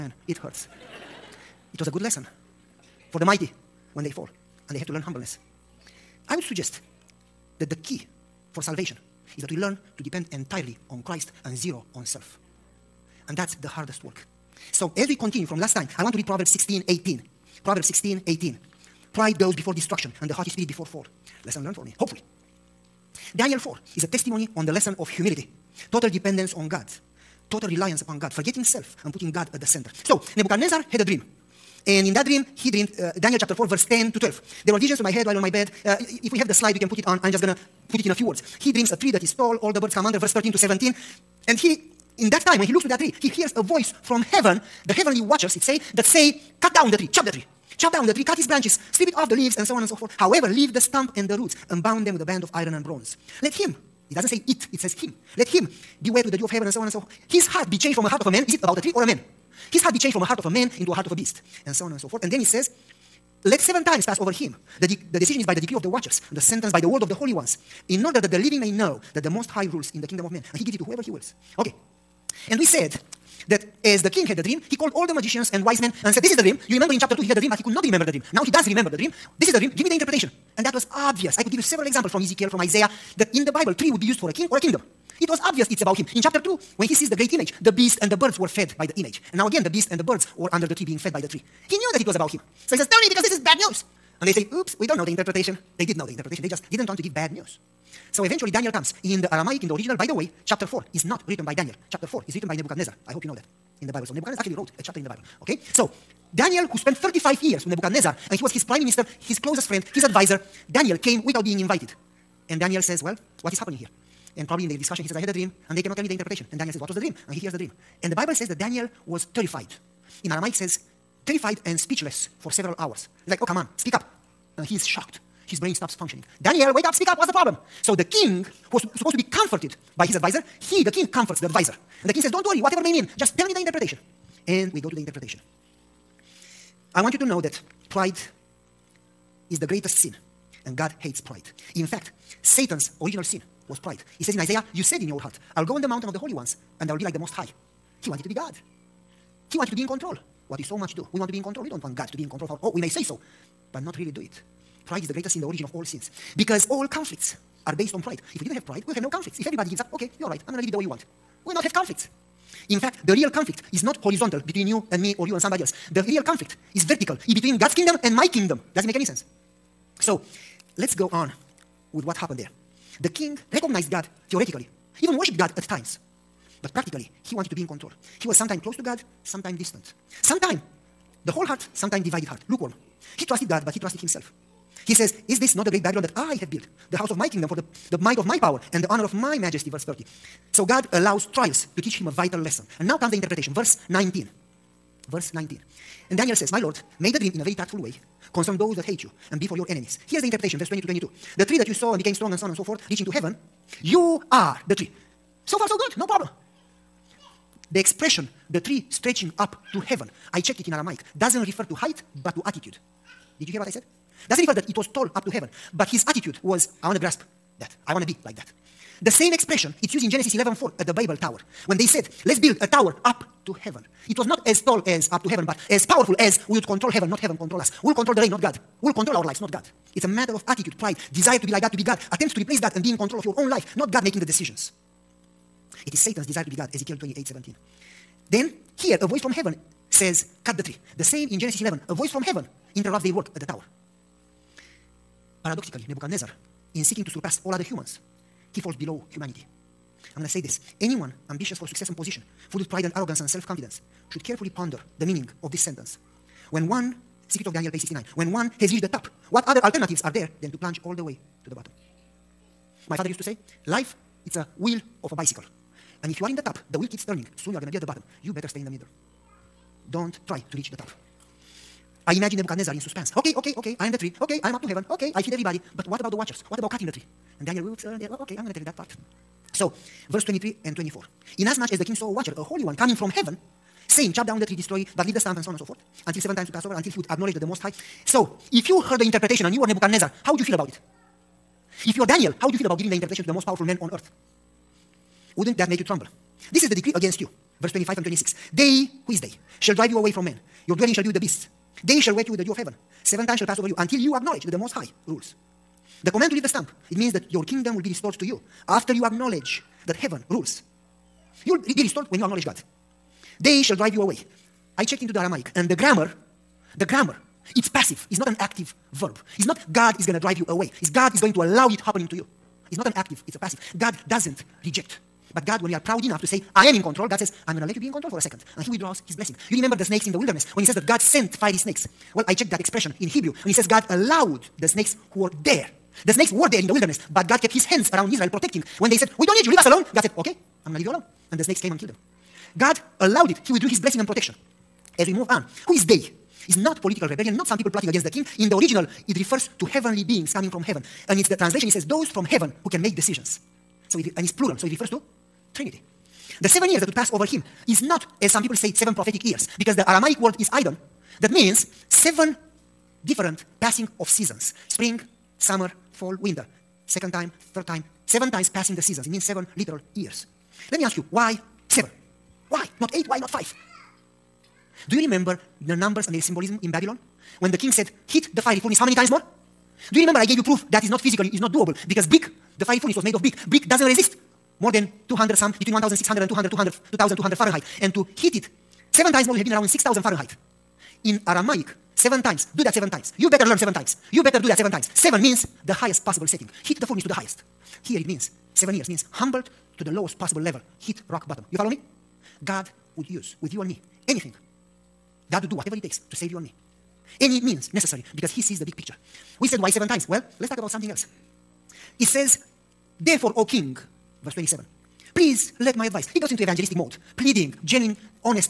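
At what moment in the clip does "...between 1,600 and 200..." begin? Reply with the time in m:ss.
6:25.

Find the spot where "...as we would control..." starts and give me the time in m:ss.
3:46.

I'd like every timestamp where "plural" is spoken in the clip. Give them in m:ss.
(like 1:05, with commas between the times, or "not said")
5:54.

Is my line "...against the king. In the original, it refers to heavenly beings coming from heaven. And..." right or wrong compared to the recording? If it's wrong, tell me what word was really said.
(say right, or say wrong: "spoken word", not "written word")
right.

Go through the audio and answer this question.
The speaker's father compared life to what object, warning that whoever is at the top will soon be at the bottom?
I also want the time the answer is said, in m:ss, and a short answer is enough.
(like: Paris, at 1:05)
wheel of a bicycle, at 4:24.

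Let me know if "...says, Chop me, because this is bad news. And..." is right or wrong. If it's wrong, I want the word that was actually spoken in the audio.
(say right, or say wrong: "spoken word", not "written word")
wrong: "Tell", not "Chop".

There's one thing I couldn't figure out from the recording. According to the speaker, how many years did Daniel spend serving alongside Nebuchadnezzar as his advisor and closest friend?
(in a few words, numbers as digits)
35.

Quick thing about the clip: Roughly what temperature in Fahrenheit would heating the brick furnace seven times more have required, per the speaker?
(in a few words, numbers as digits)
6,000.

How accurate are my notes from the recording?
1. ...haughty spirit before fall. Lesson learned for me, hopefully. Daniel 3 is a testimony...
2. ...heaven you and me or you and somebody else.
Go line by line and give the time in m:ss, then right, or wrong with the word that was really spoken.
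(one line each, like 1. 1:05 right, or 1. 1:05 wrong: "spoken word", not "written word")
1. 0:20 wrong: "4", not "3"
2. 2:44 wrong: "between", not "heaven".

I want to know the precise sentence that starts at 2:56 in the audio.
But practically, he wanted to be in control.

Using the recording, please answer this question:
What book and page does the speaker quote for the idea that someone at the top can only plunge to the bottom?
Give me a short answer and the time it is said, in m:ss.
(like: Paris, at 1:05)
Secrets of Daniel, page 69, at 4:17.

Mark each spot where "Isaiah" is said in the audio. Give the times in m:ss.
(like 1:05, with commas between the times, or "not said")
1:22, 2:24.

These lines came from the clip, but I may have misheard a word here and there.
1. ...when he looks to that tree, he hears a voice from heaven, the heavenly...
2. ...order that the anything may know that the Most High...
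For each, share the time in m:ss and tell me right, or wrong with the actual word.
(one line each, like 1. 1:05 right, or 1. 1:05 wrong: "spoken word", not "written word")
1. 0:42 right
2. 1:08 wrong: "living", not "anything".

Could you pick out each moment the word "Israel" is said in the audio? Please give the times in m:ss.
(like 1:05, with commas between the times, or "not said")
5:38.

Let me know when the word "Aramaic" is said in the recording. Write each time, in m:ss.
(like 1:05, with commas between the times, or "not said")
1:39, 2:00, 3:30, 5:15, 5:59, 6:31.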